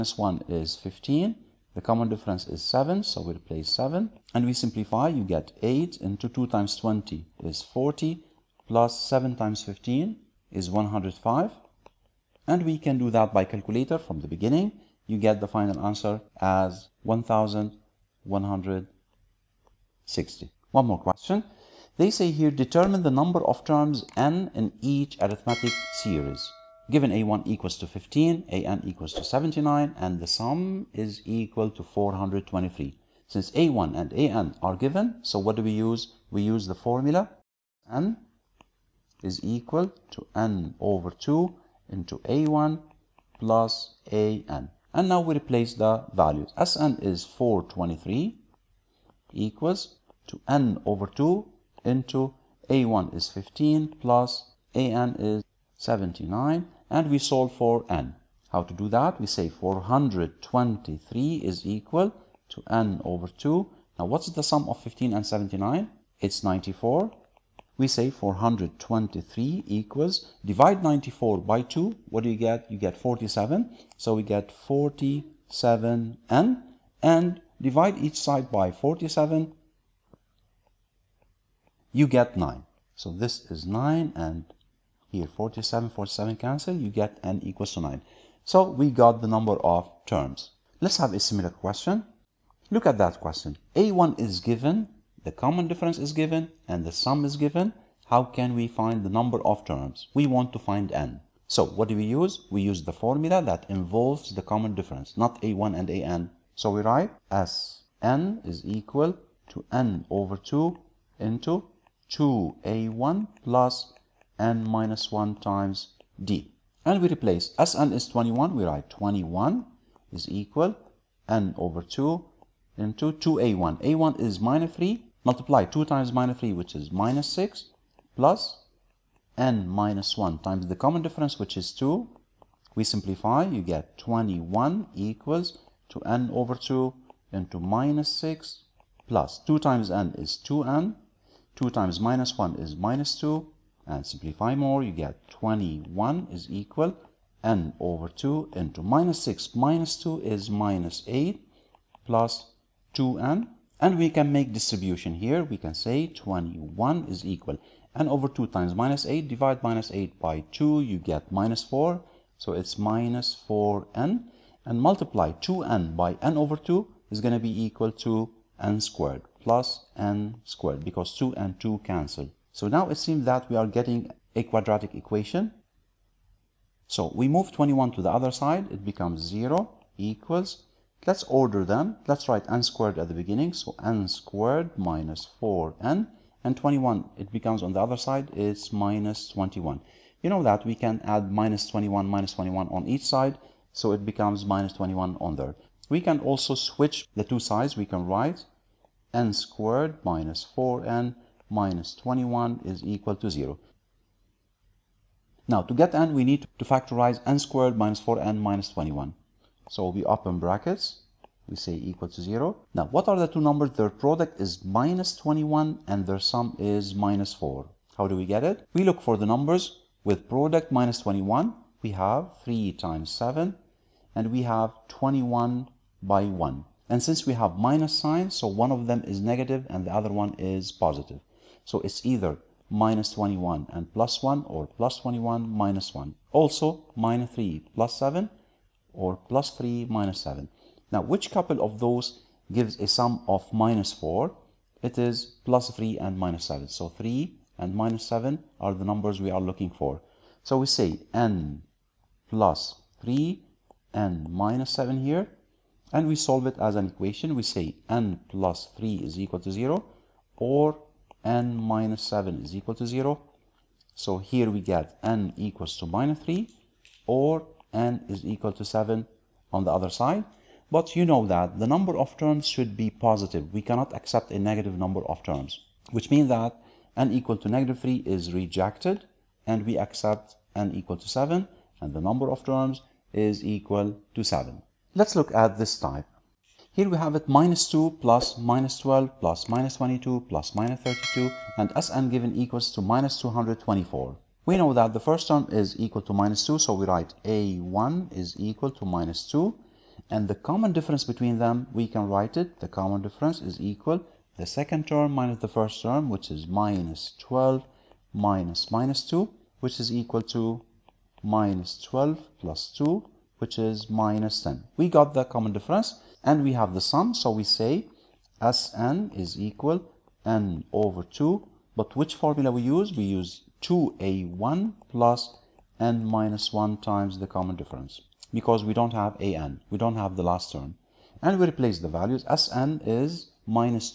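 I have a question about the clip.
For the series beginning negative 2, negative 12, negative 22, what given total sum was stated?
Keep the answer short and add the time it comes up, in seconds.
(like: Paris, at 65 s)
-224, at 292 s.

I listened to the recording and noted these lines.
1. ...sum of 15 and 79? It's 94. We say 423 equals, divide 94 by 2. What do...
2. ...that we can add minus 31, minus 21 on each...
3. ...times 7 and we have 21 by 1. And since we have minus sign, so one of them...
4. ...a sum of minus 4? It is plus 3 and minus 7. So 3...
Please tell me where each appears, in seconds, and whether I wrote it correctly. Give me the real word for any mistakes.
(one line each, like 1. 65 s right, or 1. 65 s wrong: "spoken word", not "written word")
1. 64 s right
2. 190 s wrong: "21", not "31"
3. 222 s right
4. 242 s right.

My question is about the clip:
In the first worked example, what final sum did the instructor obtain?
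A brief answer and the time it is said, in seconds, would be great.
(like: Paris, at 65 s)
1160, at 17 s.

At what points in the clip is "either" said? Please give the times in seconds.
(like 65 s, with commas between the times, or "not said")
232 s.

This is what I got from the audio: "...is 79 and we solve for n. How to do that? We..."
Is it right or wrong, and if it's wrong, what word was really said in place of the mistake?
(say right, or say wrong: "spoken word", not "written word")
right.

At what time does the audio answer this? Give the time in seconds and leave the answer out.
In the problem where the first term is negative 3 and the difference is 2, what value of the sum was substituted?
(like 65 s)
117 s.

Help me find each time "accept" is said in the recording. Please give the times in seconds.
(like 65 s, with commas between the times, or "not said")
273 s, 279 s.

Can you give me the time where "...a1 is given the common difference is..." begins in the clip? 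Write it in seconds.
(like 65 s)
93 s.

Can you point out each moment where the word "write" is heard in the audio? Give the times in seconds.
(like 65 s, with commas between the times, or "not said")
106 s, 118 s, 182 s, 198 s, 296 s, 302 s.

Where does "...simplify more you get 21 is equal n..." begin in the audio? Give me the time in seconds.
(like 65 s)
144 s.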